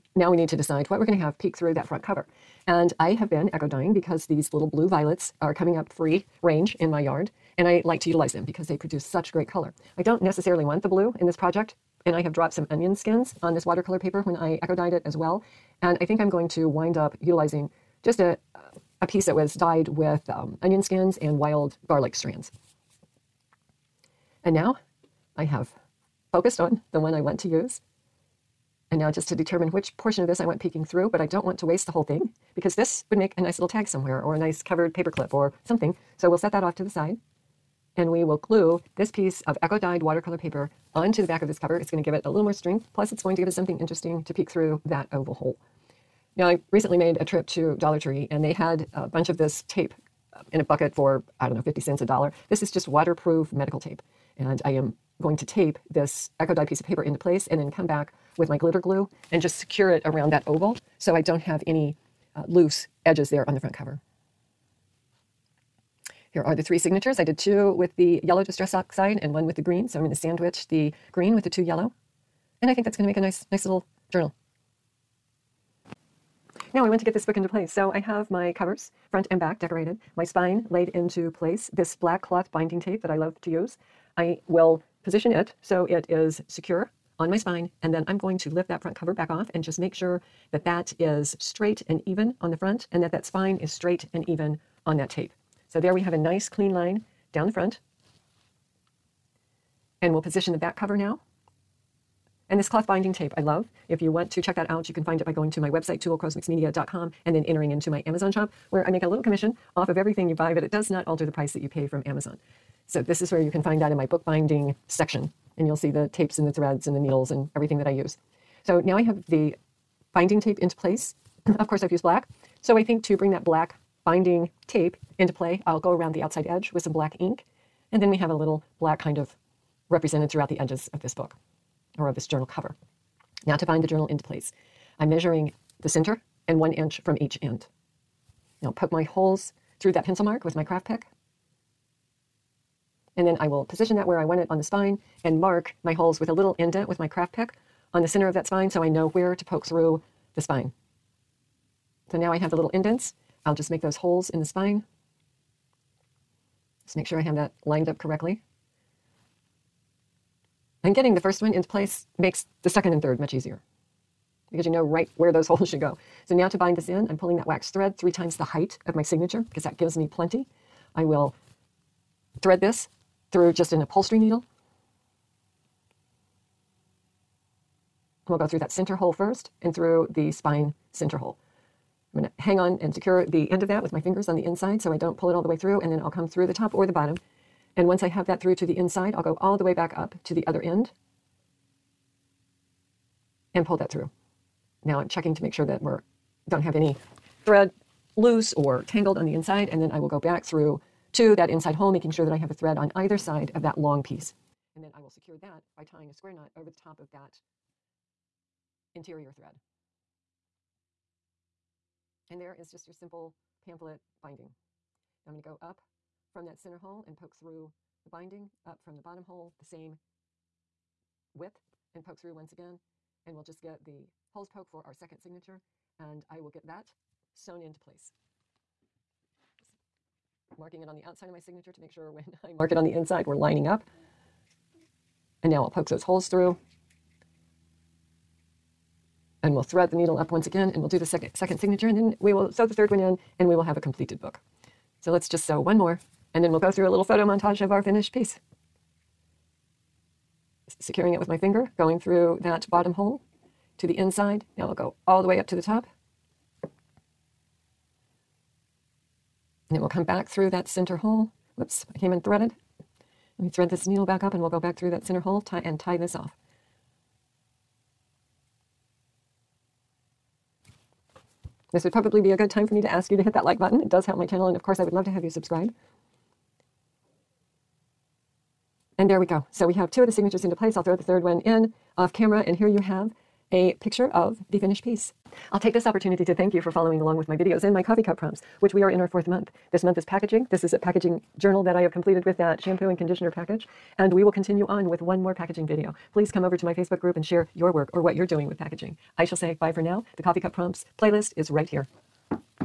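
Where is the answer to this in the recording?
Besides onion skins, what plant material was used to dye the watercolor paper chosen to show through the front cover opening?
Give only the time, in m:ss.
0:21.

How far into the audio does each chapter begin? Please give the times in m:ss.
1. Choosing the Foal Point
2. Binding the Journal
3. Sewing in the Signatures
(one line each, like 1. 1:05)
1. 0:05
2. 1:23
3. 2:19.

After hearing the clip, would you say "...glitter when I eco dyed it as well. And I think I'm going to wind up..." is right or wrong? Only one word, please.
wrong.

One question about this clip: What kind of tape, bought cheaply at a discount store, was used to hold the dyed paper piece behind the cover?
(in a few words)
waterproof medical tape.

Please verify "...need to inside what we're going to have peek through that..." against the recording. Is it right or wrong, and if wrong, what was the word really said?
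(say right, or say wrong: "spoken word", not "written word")
wrong: "decide", not "inside".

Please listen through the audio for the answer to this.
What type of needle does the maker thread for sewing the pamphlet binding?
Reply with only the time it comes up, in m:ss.
2:53.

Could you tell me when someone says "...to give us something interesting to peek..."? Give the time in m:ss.
0:43.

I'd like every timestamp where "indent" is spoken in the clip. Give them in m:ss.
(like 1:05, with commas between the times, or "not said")
2:26, 2:32.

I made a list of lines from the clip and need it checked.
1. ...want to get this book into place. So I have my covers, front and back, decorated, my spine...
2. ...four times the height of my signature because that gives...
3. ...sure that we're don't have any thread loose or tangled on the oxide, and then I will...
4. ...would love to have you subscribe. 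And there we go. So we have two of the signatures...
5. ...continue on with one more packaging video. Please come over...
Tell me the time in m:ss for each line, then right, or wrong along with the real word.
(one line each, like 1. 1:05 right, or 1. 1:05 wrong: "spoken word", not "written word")
1. 1:16 right
2. 2:47 wrong: "three", not "four"
3. 3:15 wrong: "inside", not "oxide"
4. 4:34 right
5. 4:54 right.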